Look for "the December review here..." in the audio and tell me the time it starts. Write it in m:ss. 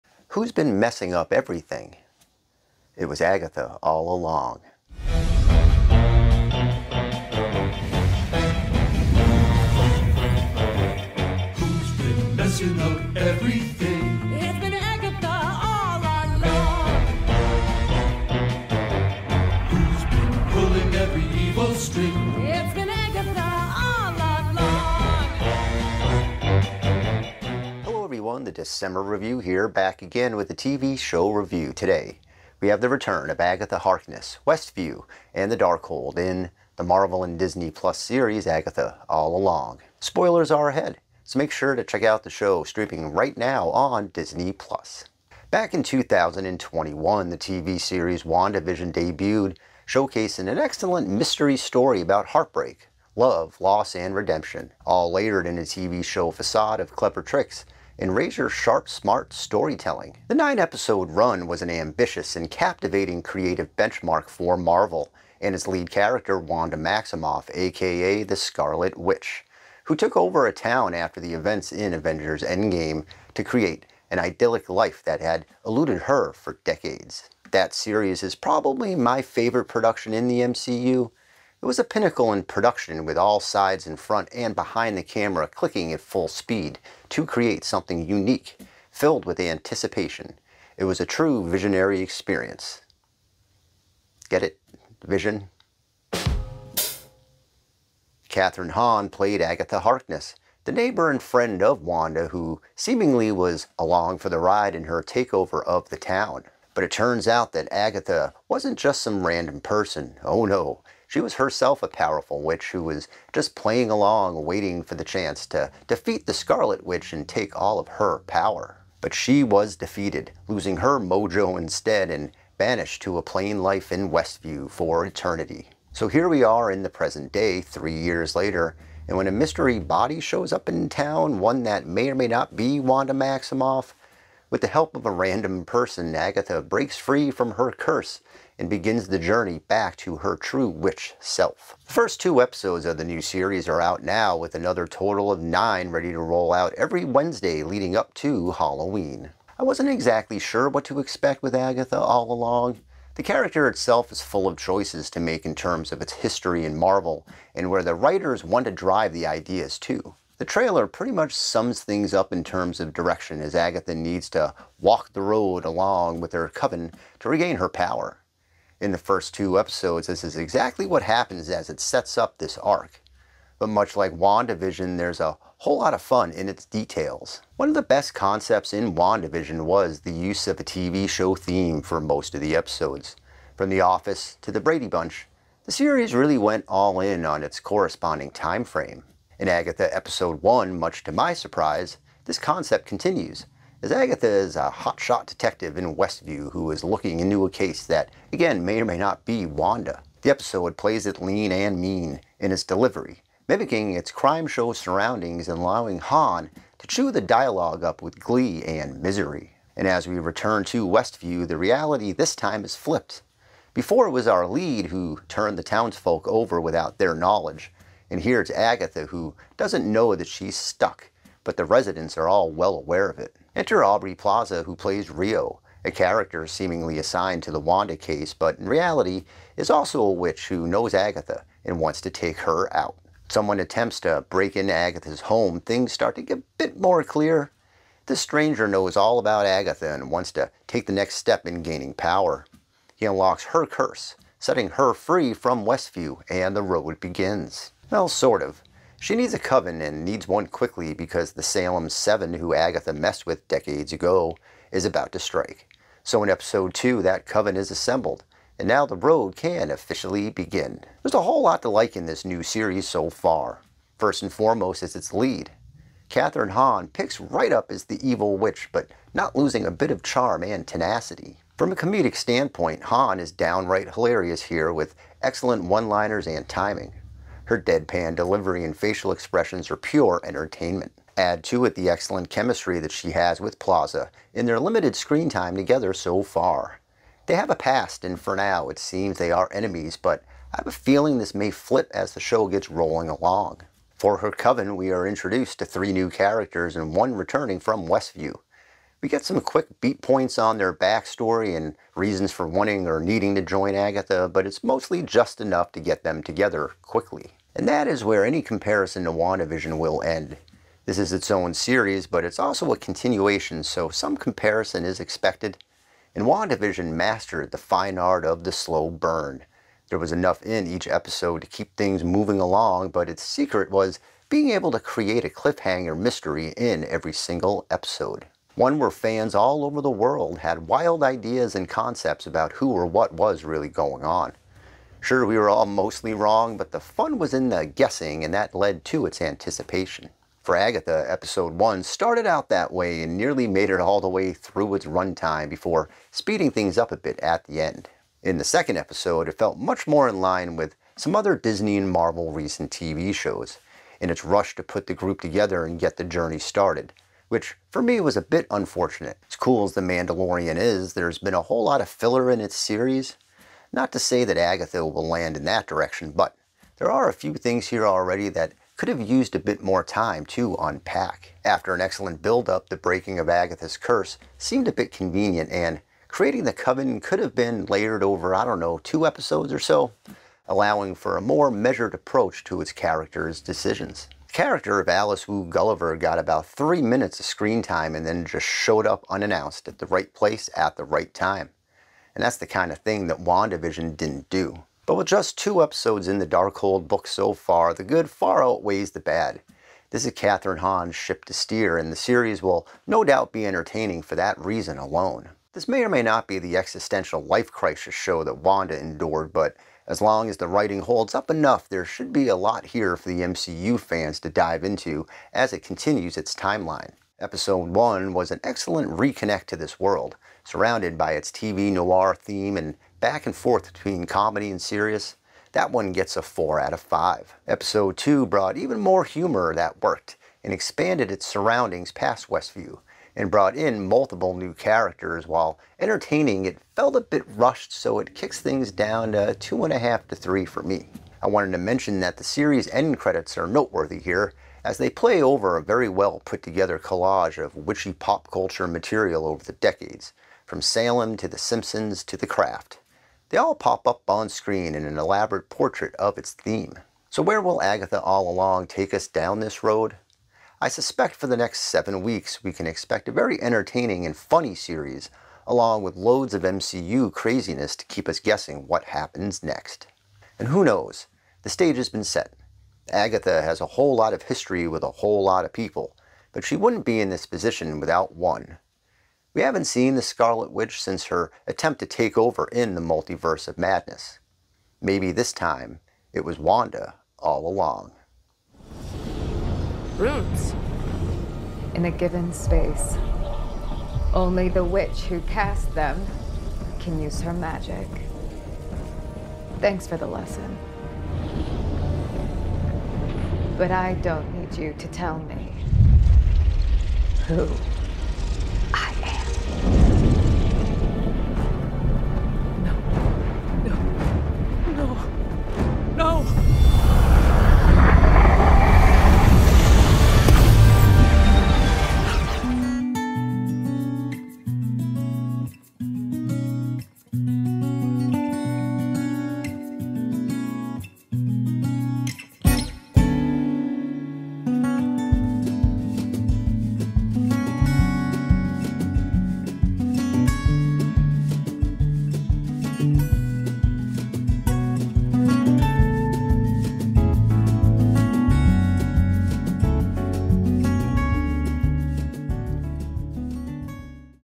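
0:28.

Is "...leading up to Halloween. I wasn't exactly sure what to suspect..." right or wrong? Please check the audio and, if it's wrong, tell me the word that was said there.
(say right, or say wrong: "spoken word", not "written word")
wrong: "expect", not "suspect".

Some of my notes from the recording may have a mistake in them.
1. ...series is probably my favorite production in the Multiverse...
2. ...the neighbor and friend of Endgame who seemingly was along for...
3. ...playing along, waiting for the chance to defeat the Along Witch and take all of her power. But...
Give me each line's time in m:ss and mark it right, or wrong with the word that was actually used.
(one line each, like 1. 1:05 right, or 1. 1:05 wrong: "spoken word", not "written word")
1. 1:17 wrong: "MCU", not "Multiverse"
2. 1:40 wrong: "Wanda", not "Endgame"
3. 1:53 wrong: "Scarlet", not "Along".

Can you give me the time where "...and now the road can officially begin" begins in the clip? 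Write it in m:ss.
4:18.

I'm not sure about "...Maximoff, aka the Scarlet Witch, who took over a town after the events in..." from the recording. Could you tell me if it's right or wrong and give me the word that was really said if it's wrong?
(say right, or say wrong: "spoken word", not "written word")
right.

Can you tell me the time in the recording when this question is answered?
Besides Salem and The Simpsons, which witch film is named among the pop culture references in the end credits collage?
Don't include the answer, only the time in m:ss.
7:32.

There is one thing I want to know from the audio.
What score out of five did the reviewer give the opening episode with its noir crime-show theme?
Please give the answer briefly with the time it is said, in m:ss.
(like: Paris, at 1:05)
4, at 7:06.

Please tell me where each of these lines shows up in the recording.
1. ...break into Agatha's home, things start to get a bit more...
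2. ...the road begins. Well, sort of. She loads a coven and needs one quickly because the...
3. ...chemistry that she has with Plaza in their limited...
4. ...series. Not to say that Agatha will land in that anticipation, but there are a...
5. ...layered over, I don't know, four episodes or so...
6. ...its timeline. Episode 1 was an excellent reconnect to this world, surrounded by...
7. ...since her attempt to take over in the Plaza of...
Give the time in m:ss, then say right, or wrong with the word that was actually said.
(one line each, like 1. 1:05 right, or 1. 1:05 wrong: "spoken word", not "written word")
1. 3:54 right
2. 4:06 wrong: "needs", not "loads"
3. 4:42 right
4. 6:02 wrong: "direction", not "anticipation"
5. 6:17 wrong: "two", not "four"
6. 6:56 right
7. 8:00 wrong: "Multiverse", not "Plaza".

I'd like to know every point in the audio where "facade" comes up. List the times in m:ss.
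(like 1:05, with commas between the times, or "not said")
0:56.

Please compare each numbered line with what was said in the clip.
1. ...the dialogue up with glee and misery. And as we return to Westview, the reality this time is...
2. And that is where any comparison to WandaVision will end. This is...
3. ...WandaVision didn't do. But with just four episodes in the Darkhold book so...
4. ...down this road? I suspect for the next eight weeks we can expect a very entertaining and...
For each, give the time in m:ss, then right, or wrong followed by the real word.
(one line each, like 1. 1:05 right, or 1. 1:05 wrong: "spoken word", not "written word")
1. 3:27 right
2. 5:07 right
3. 6:33 wrong: "two", not "four"
4. 7:39 wrong: "seven", not "eight".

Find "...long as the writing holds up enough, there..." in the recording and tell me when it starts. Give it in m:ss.
6:50.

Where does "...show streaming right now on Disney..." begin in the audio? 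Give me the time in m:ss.
0:42.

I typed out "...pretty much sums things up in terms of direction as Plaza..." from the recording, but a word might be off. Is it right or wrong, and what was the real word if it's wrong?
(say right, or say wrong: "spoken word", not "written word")
wrong: "Agatha", not "Plaza".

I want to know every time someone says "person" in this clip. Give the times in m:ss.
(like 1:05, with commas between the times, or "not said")
1:49, 2:15.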